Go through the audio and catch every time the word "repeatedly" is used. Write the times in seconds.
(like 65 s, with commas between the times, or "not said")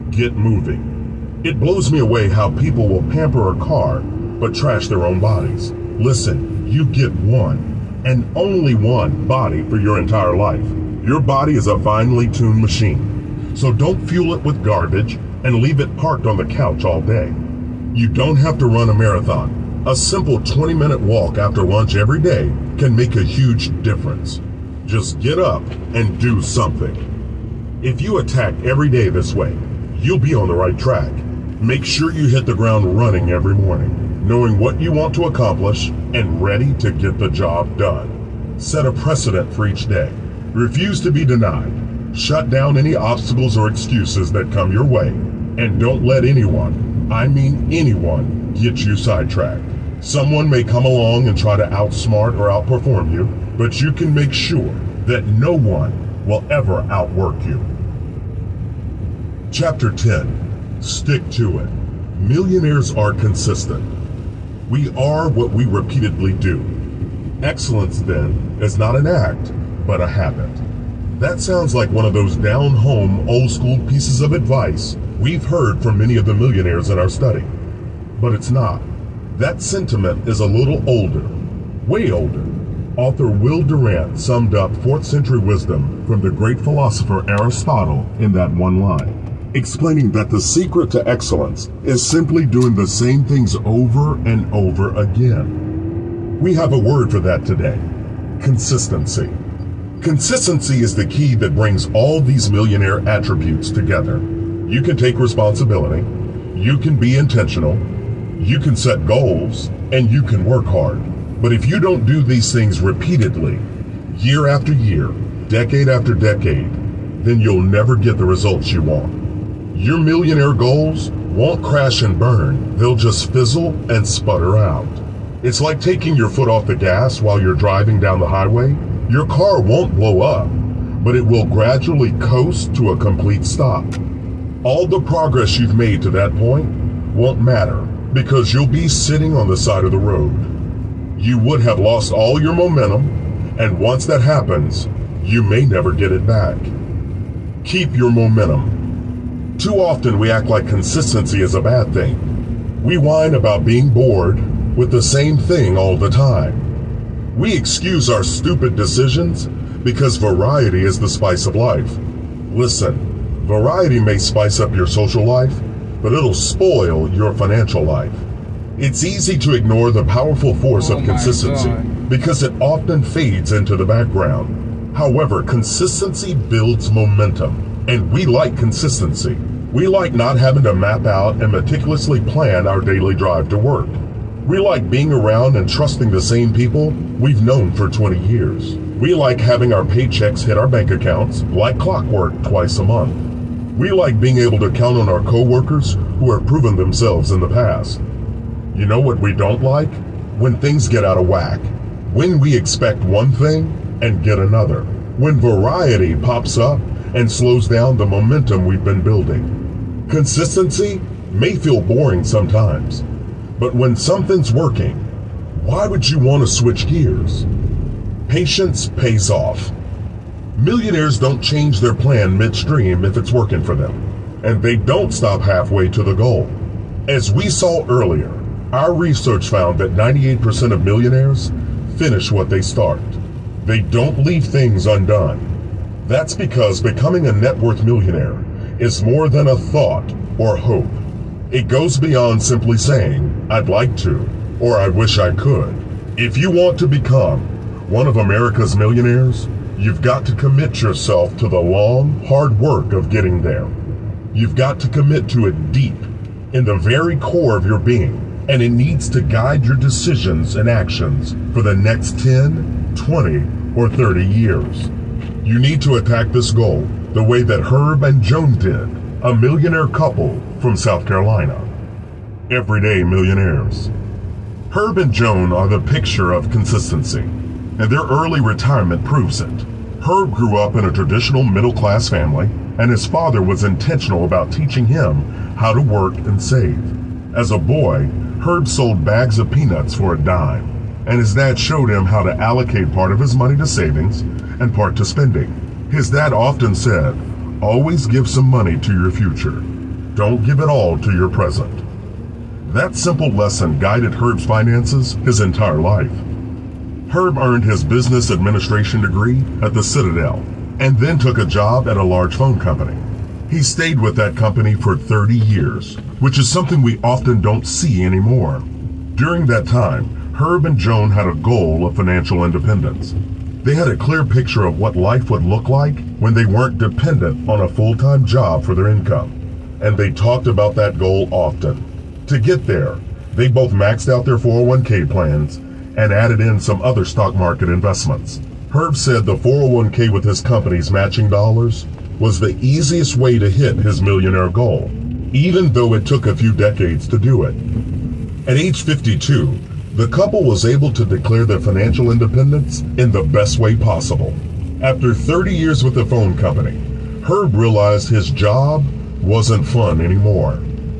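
65 s, 112 s.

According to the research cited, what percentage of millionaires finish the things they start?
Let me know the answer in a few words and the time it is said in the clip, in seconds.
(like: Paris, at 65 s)
98%, at 229 s.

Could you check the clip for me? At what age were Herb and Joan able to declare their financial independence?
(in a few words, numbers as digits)
52.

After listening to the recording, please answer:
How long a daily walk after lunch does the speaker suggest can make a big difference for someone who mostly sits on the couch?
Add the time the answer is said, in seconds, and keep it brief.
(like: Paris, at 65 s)
20 minutes, at 20 s.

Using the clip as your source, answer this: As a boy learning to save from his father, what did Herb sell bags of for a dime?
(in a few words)
Peanuts.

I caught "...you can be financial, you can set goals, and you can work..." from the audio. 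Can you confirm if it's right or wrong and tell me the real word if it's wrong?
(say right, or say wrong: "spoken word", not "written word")
wrong: "intentional", not "financial".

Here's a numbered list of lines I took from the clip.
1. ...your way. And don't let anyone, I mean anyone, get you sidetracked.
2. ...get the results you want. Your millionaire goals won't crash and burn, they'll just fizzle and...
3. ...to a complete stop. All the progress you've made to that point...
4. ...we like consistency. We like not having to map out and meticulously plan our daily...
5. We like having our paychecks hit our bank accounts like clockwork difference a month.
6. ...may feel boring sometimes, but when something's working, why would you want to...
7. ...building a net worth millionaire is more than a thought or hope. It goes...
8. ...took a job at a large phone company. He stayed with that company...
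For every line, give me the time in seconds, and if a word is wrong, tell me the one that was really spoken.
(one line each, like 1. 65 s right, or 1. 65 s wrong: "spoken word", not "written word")
1. 44 s right
2. 117 s right
3. 132 s right
4. 178 s right
5. 188 s wrong: "twice", not "difference"
6. 211 s right
7. 236 s wrong: "becoming", not "building"
8. 311 s right.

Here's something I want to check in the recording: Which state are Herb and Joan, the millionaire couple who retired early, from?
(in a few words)
South Carolina.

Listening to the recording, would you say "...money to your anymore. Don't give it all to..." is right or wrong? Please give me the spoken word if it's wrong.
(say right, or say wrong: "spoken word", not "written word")
wrong: "future", not "anymore".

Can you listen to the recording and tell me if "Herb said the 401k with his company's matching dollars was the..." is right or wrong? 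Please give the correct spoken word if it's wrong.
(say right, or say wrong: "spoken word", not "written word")
right.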